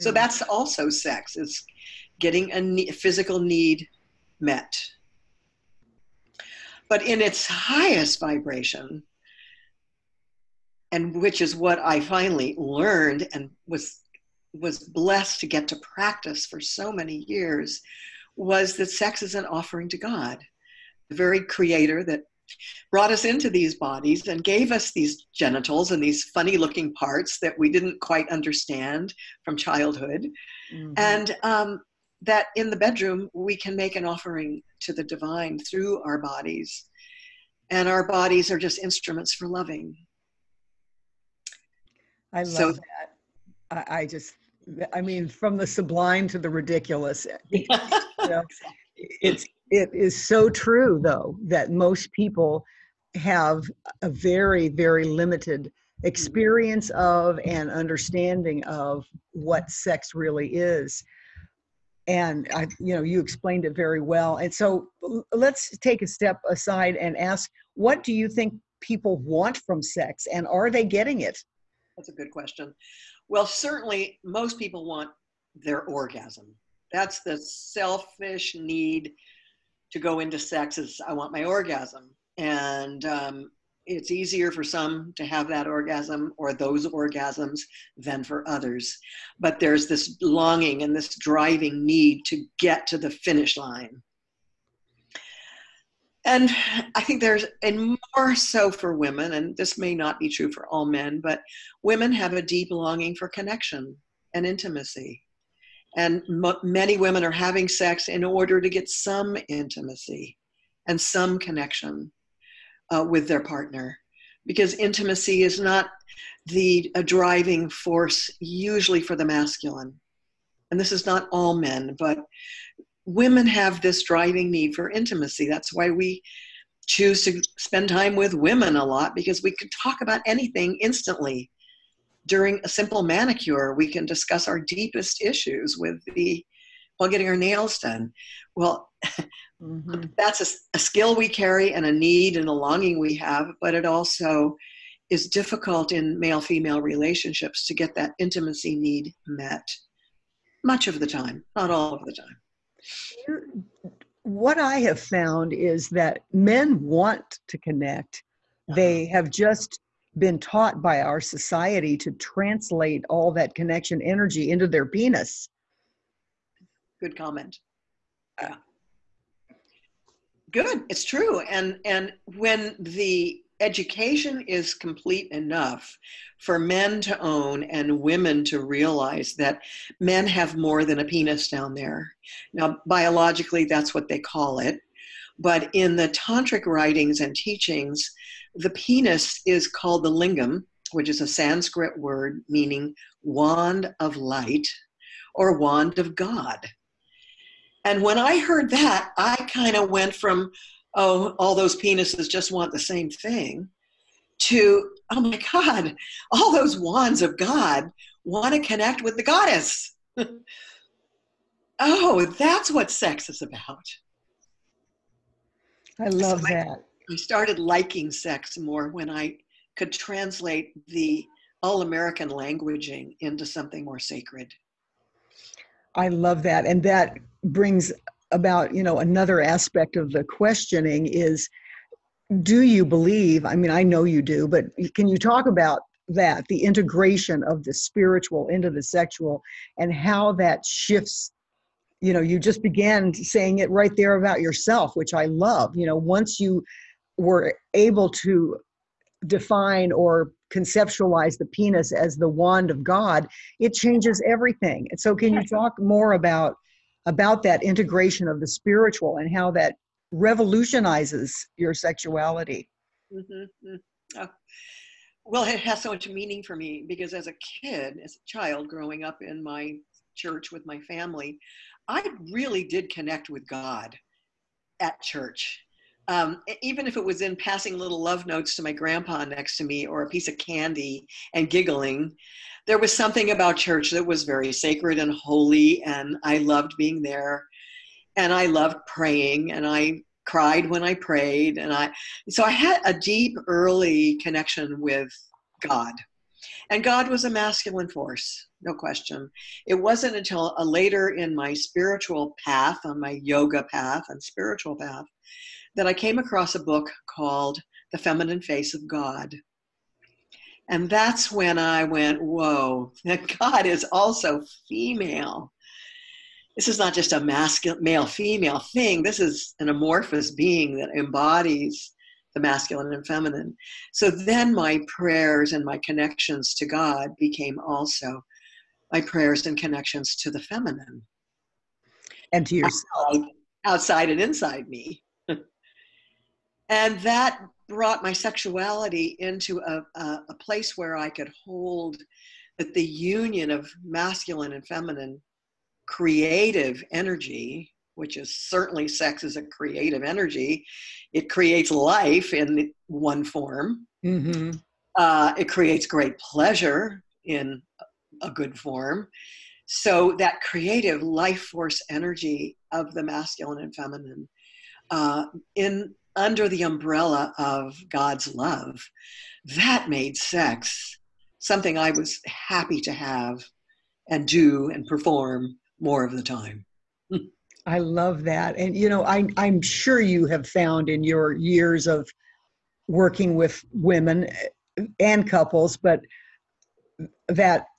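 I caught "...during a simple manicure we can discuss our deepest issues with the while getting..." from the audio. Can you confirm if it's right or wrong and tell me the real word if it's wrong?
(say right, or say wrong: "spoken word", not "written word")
right.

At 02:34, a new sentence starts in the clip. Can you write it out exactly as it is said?
What I have found is that men want to connect.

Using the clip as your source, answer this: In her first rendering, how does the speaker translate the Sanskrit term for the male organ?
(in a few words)
wand of light.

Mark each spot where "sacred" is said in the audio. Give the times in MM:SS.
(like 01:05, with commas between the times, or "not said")
03:43, 04:44.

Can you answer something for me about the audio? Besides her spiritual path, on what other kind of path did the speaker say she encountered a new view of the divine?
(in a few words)
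yoga path.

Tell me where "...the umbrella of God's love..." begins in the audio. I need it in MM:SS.
06:06.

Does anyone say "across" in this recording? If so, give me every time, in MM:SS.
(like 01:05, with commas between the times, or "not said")
05:06.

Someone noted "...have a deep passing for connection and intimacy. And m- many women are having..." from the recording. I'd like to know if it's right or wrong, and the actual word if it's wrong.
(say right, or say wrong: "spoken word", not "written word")
wrong: "longing", not "passing".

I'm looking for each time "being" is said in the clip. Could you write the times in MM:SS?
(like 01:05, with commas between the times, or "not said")
04:46, 05:20.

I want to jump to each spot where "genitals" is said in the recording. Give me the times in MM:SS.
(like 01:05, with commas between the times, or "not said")
00:25.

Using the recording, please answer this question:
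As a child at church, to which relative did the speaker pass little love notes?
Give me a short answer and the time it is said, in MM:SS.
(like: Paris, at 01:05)
grandpa, at 04:38.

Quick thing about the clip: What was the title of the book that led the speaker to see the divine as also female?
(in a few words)
The Feminine Face of God.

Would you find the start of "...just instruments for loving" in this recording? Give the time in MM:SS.
00:38.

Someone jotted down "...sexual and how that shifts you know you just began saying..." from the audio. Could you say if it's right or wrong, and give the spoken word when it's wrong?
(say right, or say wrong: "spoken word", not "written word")
right.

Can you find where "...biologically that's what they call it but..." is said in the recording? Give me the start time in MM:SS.
03:02.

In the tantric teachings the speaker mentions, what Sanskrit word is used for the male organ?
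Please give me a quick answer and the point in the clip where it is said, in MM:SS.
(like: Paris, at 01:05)
lingam, at 03:10.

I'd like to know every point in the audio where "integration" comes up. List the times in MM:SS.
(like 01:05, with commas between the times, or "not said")
03:56, 04:17.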